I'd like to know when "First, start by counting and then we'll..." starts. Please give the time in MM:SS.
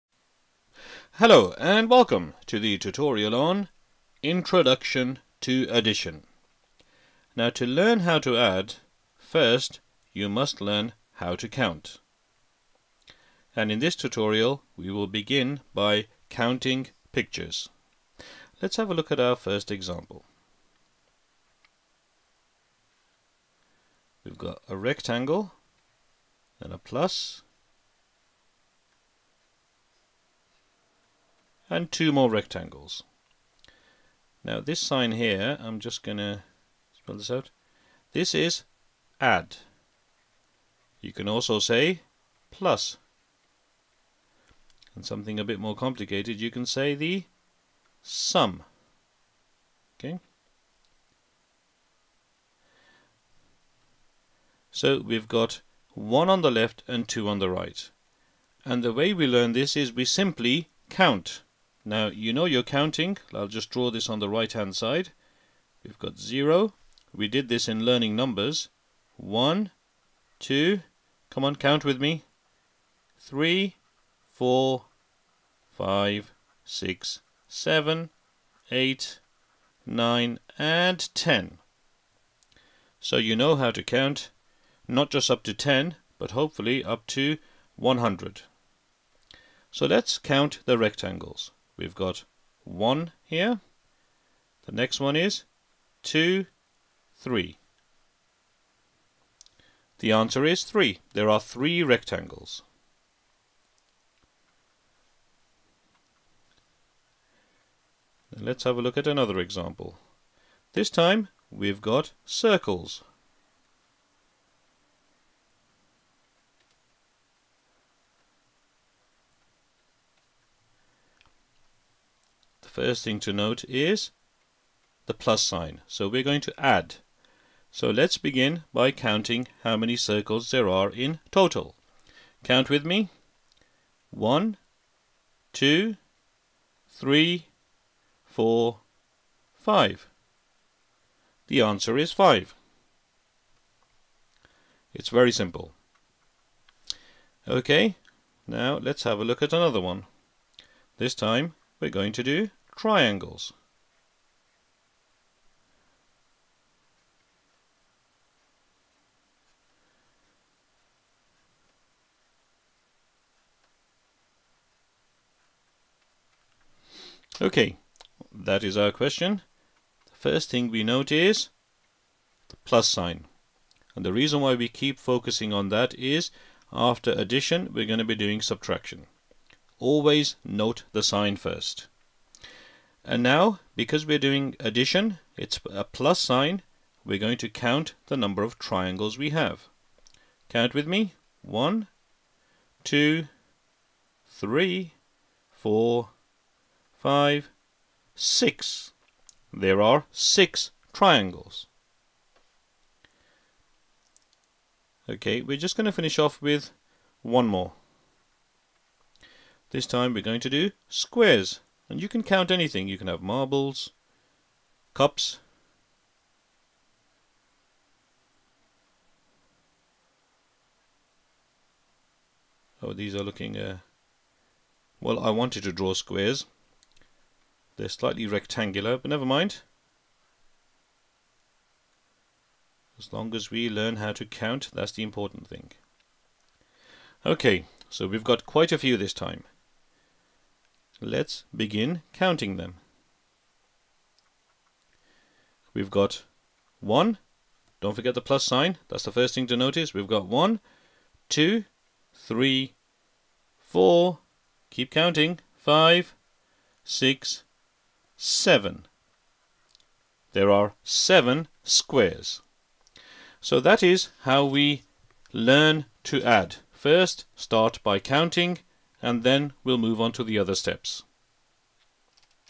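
04:26.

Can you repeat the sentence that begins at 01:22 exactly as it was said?
So you know how to count, not just up to 10, but hopefully up to 100.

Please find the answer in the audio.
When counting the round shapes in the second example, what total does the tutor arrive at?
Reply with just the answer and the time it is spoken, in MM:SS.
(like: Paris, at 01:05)
5, at 02:21.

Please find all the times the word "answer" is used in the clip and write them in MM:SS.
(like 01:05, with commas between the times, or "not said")
01:40, 02:21.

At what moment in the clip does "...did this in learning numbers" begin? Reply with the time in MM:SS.
01:07.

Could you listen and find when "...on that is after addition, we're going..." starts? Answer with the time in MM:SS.
02:55.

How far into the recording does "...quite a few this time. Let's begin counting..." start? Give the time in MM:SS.
03:58.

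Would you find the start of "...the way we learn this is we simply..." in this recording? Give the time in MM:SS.
00:58.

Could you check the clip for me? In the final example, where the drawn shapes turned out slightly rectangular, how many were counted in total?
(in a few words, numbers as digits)
7.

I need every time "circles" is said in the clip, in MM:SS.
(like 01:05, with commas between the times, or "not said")
01:52, 02:09.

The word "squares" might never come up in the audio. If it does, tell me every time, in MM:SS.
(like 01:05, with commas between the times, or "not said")
03:30, 03:45, 04:21.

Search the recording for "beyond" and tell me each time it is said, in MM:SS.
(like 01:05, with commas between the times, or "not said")
not said.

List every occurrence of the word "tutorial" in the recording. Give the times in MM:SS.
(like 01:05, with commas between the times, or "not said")
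00:02, 00:13.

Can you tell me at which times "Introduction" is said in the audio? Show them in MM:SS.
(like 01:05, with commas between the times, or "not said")
00:04.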